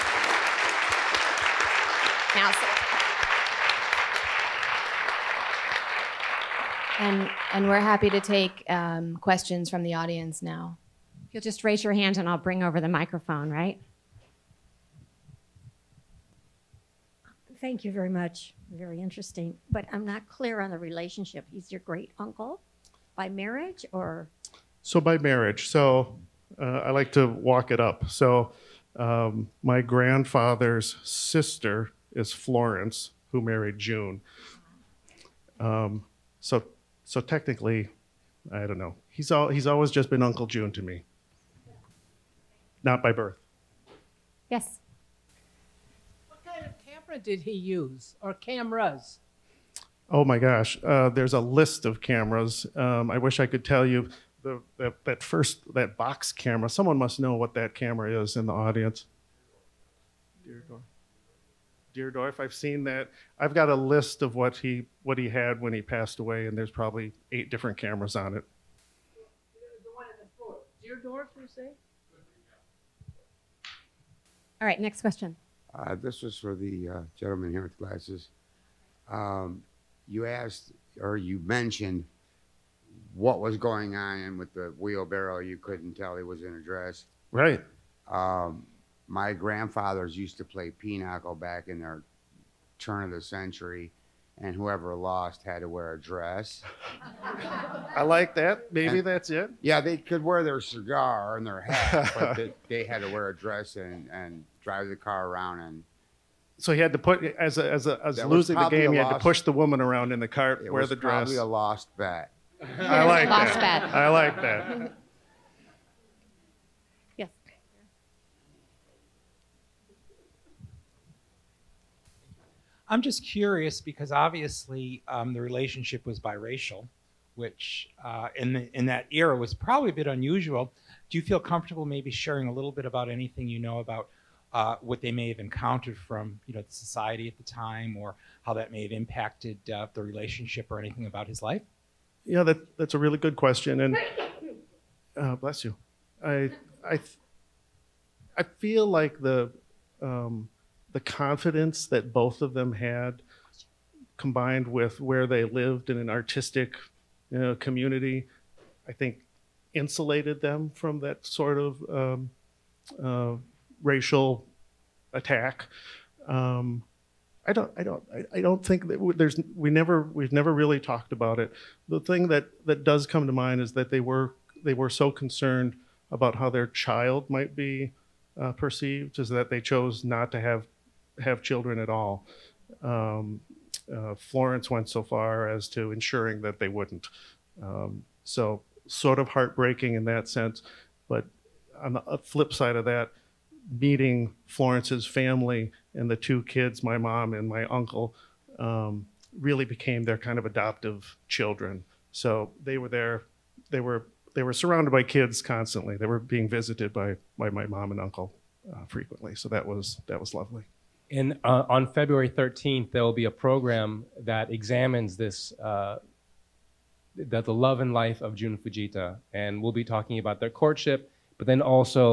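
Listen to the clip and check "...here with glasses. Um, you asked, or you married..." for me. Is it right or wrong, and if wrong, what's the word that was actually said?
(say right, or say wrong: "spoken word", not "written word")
wrong: "mentioned", not "married".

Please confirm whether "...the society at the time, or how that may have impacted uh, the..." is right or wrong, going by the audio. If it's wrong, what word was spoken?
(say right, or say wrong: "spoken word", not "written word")
right.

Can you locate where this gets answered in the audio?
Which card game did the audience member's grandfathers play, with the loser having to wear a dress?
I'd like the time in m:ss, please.
1:30.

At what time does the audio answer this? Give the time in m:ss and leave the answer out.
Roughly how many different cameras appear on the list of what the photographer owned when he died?
1:07.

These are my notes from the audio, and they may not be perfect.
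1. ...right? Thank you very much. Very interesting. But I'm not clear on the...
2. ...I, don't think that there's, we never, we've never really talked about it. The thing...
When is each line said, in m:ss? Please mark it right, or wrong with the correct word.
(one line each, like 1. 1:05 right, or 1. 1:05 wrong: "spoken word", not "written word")
1. 0:13 right
2. 2:48 right.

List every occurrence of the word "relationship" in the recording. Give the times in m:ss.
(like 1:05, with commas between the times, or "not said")
0:20, 2:05, 2:20.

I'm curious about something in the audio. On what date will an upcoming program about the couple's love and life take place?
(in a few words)
February 13.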